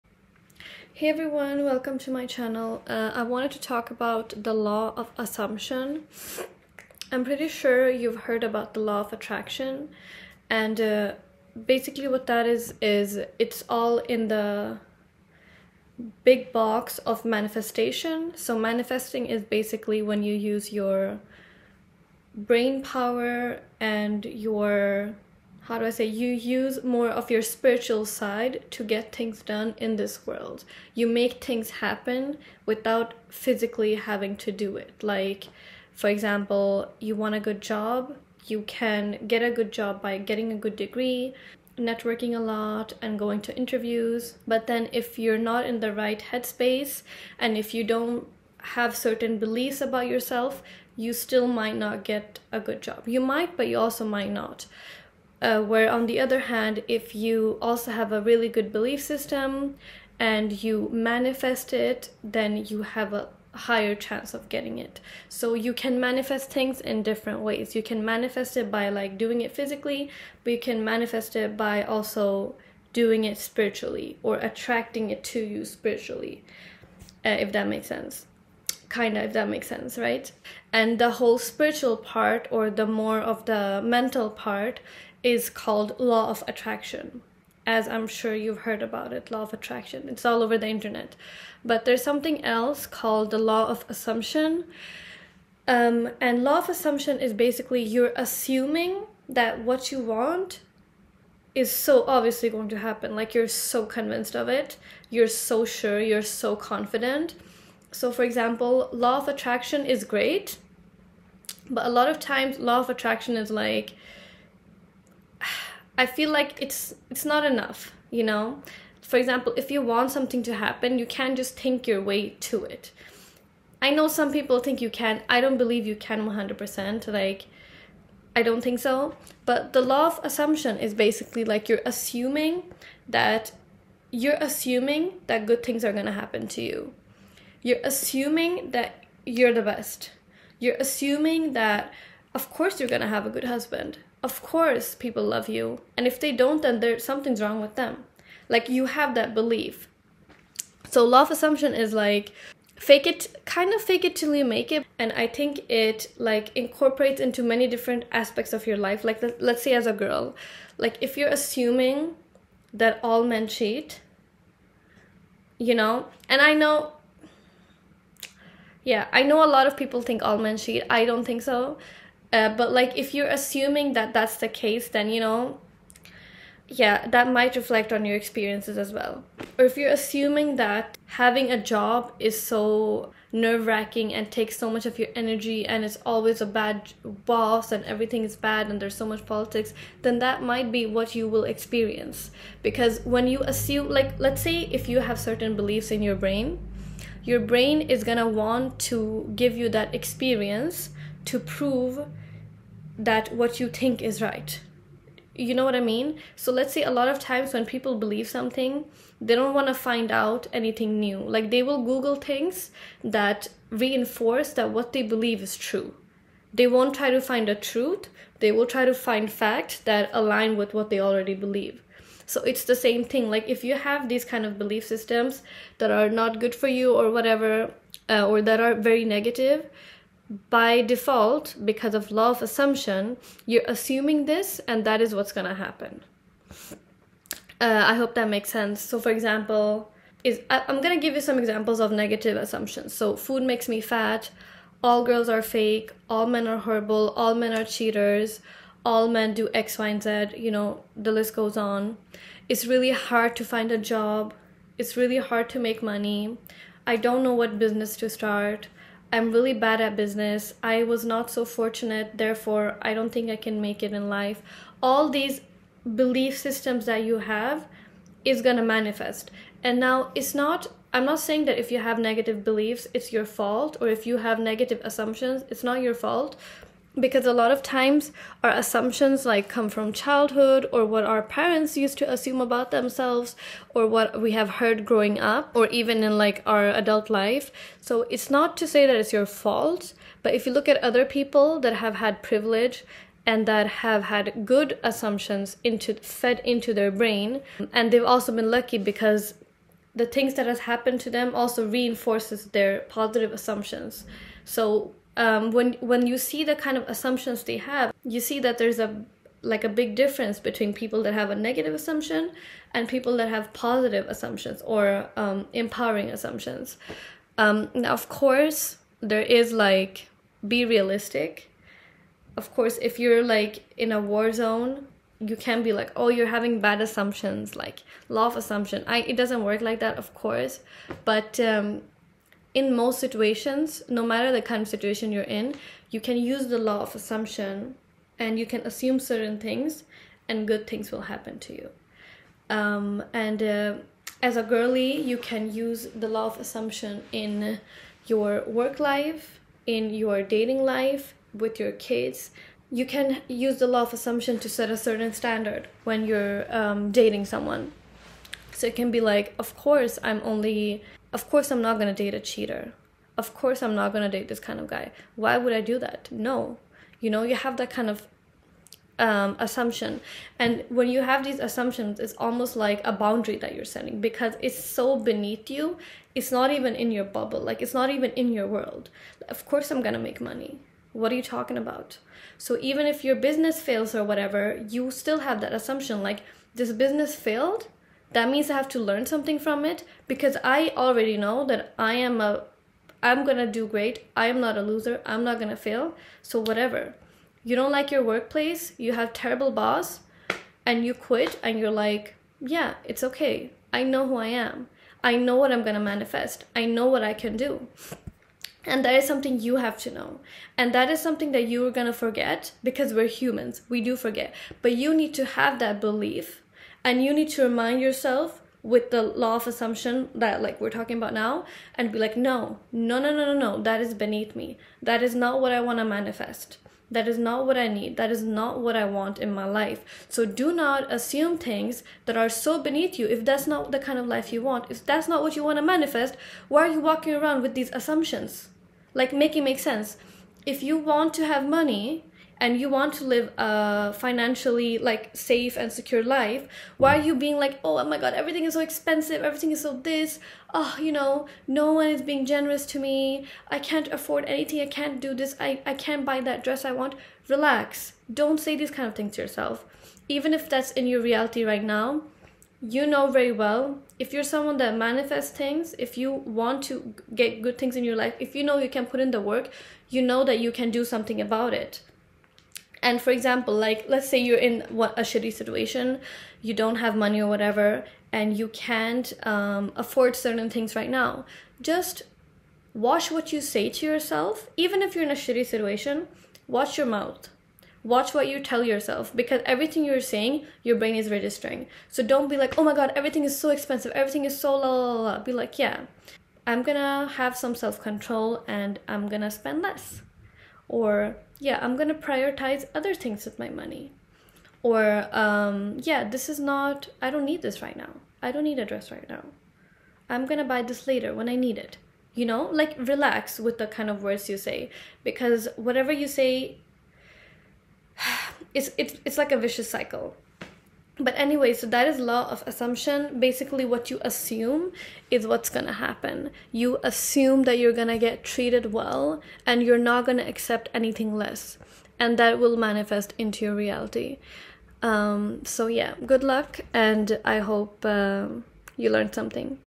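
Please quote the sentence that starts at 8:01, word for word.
Just watch what you say to yourself, even if you're in a shitty situation.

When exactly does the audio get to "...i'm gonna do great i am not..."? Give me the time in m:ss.
6:33.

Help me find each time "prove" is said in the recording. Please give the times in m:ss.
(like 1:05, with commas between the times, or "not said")
3:21.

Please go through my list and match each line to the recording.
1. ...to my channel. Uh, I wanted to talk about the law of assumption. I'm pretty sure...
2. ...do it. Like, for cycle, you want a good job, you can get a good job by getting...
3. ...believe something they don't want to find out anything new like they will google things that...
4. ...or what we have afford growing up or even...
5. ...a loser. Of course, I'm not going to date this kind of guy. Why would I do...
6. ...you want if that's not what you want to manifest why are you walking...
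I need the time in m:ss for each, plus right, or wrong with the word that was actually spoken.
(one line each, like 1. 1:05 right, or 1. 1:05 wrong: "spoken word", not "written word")
1. 0:01 right
2. 0:34 wrong: "example", not "cycle"
3. 3:27 right
4. 4:43 wrong: "heard", not "afford"
5. 6:02 wrong: "cheater", not "loser"
6. 7:14 right.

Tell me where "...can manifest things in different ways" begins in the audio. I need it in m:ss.
1:05.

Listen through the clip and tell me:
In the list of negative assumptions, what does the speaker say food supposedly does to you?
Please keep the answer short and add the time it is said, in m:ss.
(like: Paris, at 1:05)
makes me fat, at 4:03.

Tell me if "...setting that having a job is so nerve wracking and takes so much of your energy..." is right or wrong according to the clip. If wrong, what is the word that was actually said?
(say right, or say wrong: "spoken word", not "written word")
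wrong: "assuming", not "setting".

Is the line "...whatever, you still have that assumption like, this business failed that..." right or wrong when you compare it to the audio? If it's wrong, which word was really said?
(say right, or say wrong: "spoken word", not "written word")
right.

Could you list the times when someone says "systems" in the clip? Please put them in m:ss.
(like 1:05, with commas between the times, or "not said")
0:59, 3:44, 4:26.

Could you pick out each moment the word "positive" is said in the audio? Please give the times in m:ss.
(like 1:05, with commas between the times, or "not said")
5:02, 5:13.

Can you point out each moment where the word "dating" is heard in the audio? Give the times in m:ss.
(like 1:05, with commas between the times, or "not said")
5:50, 5:56.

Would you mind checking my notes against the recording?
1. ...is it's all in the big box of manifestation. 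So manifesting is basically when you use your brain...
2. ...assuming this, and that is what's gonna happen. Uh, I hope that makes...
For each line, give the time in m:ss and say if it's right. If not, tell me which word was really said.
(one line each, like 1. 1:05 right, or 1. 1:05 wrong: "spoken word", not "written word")
1. 0:12 right
2. 3:53 right.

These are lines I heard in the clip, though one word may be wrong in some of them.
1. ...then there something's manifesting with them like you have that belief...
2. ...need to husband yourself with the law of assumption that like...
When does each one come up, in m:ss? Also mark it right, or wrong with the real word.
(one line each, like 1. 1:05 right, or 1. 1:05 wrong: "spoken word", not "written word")
1. 2:26 wrong: "wrong", not "manifesting"
2. 6:57 wrong: "remind", not "husband".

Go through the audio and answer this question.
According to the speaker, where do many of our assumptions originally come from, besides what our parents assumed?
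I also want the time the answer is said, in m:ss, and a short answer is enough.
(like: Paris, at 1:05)
childhood, at 4:39.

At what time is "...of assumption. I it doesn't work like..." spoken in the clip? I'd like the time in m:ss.
5:28.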